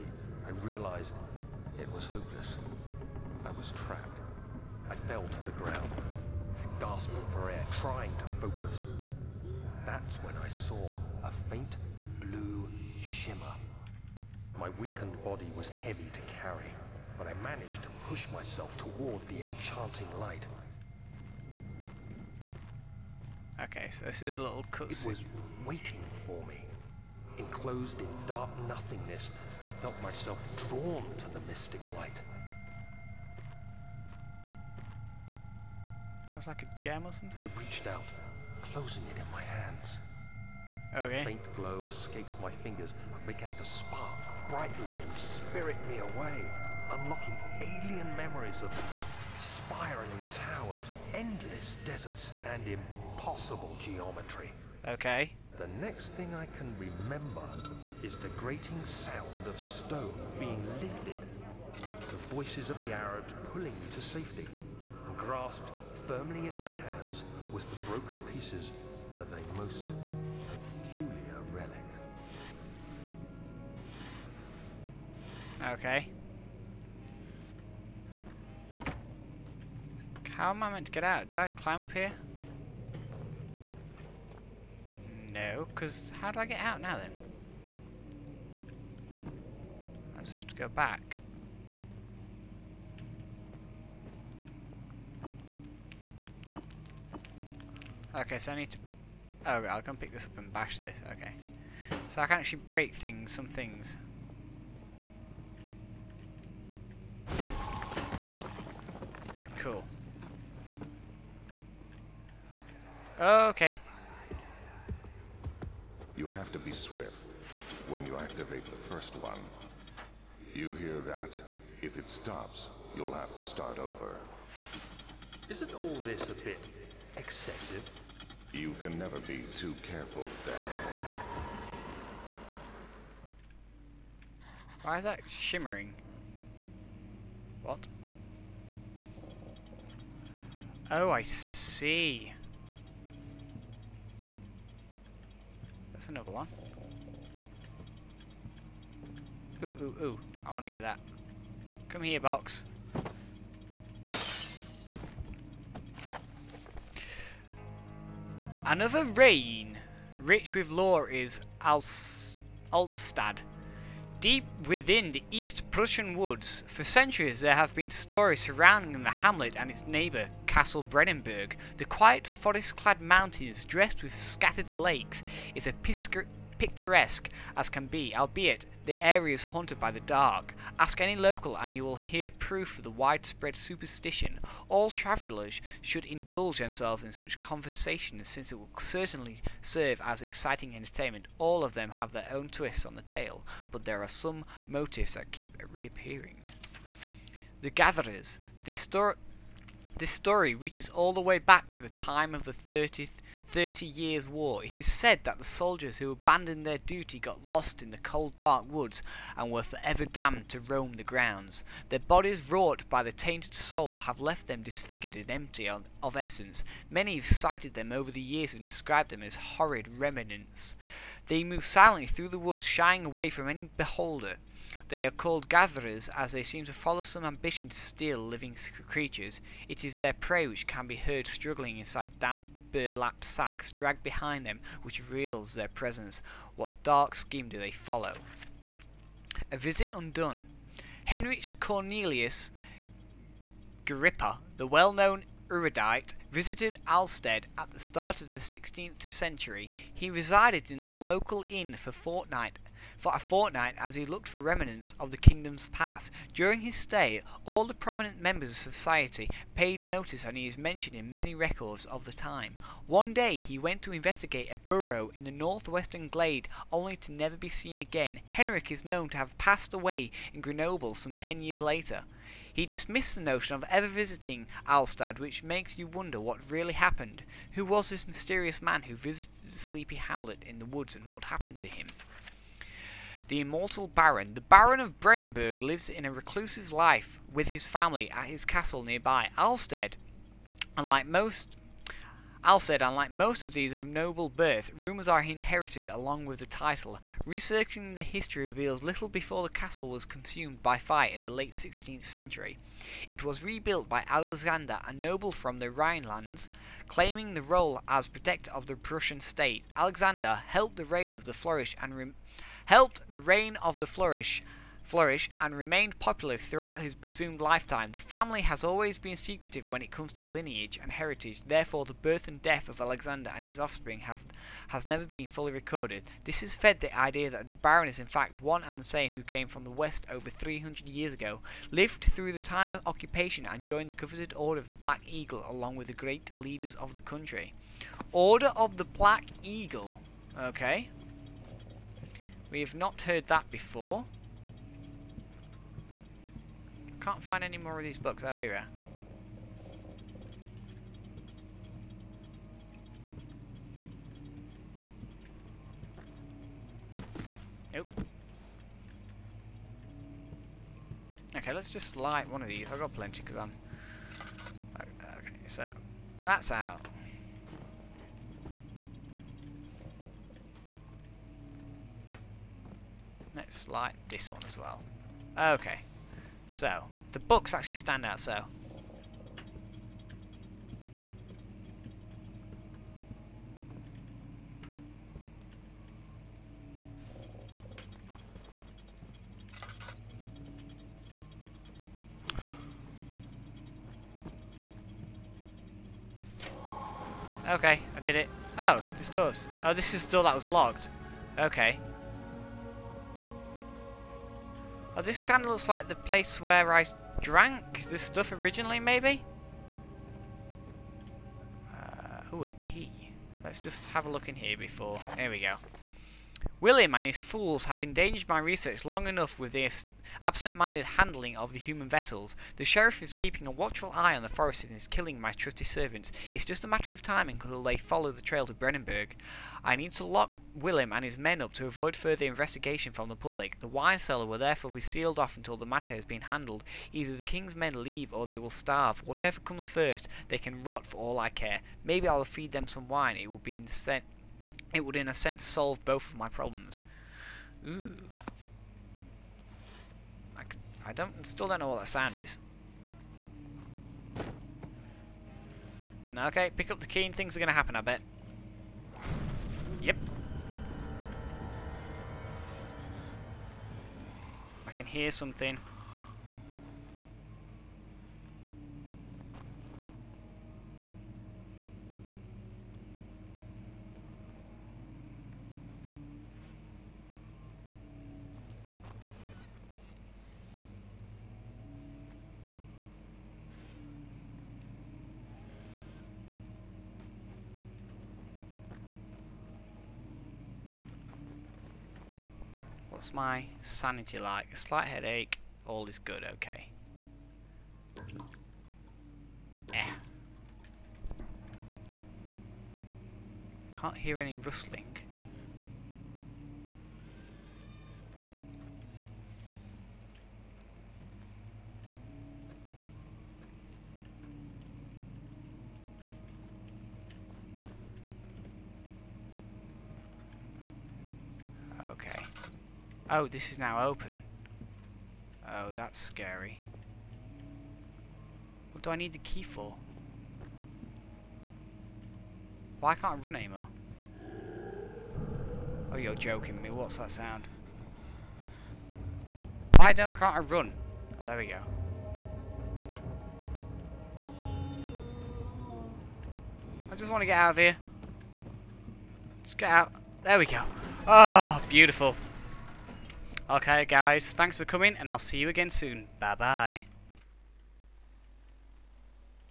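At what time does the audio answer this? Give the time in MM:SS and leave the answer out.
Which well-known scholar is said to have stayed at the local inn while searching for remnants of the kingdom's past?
04:01.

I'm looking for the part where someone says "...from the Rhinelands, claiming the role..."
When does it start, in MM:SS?
05:05.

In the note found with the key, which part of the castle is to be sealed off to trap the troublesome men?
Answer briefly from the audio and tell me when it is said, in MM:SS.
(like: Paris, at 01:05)
The wine cellar, at 07:13.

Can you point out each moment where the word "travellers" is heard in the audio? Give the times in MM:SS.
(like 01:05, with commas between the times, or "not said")
03:04.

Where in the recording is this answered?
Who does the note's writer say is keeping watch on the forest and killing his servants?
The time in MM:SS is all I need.
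07:02.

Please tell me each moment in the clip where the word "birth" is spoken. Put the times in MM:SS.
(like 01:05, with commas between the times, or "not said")
04:54, 05:21.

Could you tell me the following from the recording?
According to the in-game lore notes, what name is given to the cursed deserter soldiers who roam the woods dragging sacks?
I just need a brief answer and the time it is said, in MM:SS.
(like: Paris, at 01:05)
The Gatherers, at 03:17.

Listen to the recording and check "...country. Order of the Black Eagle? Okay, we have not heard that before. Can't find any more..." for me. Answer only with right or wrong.
right.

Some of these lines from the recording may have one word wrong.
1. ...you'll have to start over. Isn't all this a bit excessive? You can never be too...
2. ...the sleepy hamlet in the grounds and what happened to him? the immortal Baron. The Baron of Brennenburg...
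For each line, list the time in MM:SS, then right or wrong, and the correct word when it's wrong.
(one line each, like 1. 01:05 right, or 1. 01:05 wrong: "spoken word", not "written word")
1. 02:02 right
2. 04:39 wrong: "woods", not "grounds".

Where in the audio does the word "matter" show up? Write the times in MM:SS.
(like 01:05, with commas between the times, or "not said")
07:06, 07:15.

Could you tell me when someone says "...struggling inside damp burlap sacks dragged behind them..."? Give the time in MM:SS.
03:51.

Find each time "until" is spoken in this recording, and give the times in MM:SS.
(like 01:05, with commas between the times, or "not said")
07:07, 07:15.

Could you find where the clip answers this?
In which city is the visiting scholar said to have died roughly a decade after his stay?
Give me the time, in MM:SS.
04:30.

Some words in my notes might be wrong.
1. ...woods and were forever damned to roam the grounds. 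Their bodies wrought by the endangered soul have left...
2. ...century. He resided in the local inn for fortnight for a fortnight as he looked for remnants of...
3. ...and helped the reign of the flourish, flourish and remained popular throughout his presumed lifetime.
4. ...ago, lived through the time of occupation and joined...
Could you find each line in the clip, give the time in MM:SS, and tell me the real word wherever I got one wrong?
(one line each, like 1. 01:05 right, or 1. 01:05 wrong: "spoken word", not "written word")
1. 03:28 wrong: "tainted", not "endangered"
2. 04:09 right
3. 05:11 right
4. 05:31 right.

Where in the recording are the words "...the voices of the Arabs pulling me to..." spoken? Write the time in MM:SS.
01:02.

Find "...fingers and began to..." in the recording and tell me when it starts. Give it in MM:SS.
00:42.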